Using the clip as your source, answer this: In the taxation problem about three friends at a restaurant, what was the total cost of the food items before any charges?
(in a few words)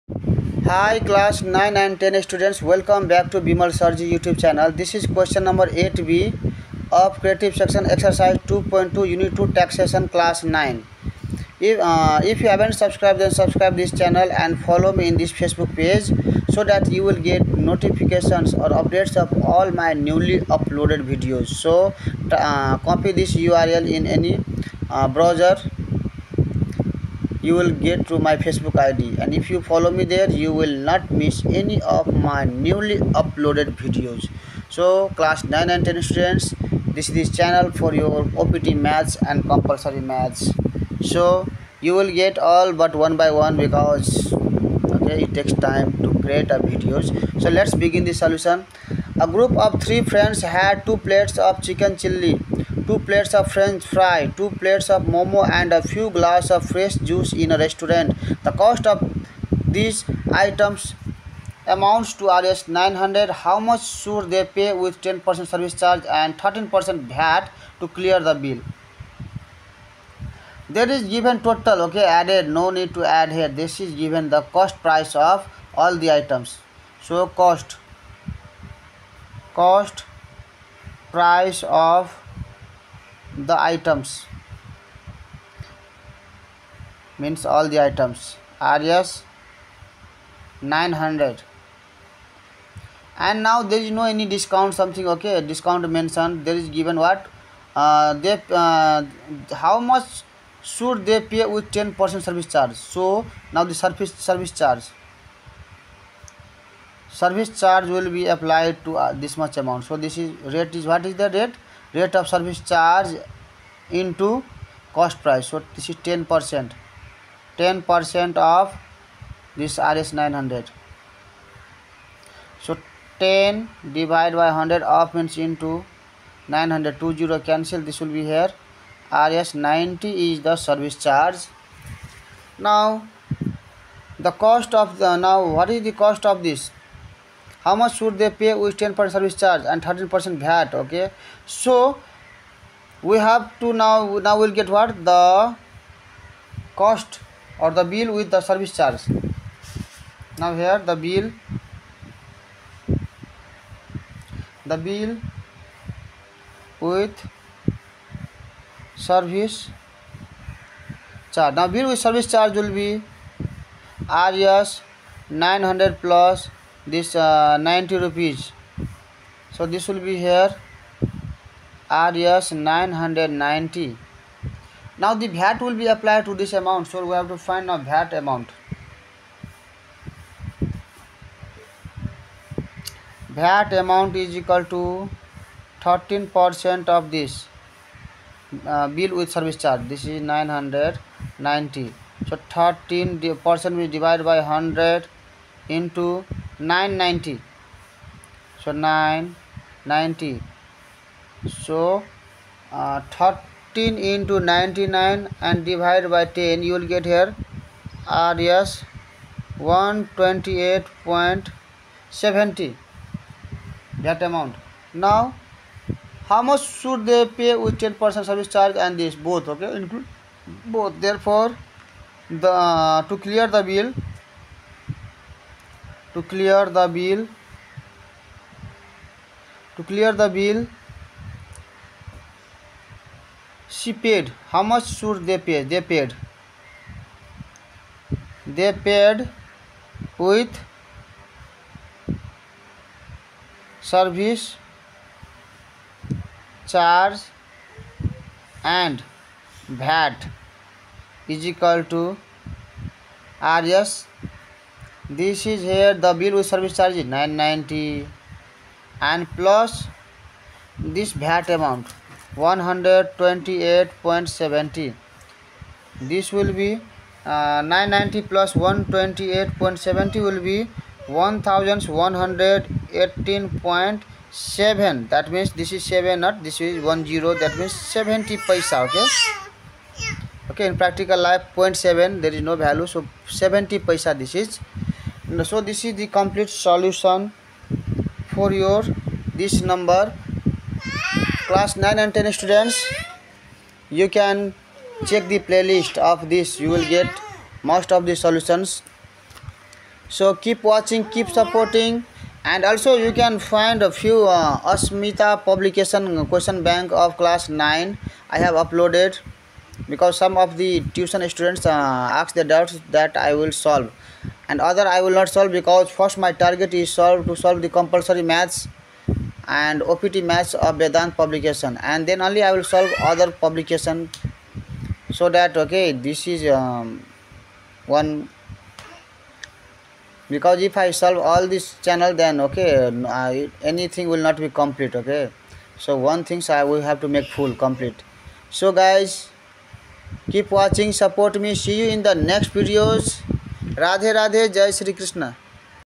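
Rs 900.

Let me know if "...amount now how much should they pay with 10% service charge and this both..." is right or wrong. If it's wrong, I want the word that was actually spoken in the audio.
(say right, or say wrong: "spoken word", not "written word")
right.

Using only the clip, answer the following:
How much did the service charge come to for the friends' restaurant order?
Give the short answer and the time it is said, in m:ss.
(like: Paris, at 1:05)
Rs 90, at 2:09.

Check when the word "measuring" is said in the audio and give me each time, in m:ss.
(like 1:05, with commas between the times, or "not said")
not said.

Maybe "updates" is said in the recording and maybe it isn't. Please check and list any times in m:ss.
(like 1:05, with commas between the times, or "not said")
0:18.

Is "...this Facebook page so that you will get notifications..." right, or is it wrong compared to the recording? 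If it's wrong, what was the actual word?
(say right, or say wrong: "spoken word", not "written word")
right.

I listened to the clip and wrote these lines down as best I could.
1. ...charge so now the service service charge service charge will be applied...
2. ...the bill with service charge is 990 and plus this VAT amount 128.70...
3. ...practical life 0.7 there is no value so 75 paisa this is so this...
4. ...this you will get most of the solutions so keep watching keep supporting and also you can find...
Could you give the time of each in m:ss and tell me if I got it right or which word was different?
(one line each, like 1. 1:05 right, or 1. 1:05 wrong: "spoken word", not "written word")
1. 1:42 right
2. 4:16 right
3. 4:40 wrong: "70", not "75"
4. 4:56 right.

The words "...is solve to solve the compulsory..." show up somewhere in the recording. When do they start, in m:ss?
5:16.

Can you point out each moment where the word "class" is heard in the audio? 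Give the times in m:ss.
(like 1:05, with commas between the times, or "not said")
0:00, 0:10, 0:35, 4:51, 5:07.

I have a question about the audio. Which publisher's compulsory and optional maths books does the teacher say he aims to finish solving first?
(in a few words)
Vedant publication.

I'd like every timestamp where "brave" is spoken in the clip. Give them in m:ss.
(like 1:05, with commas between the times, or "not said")
not said.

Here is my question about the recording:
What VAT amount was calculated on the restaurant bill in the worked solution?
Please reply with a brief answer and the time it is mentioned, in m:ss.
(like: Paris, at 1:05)
Rs 128.70, at 3:28.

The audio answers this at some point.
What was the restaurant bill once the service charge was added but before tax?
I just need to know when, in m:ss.
2:51.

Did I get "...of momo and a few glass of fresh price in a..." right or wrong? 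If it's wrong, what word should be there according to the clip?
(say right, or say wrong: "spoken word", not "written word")
wrong: "juice", not "price".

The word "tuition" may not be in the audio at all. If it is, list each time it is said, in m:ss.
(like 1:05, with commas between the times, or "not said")
5:10.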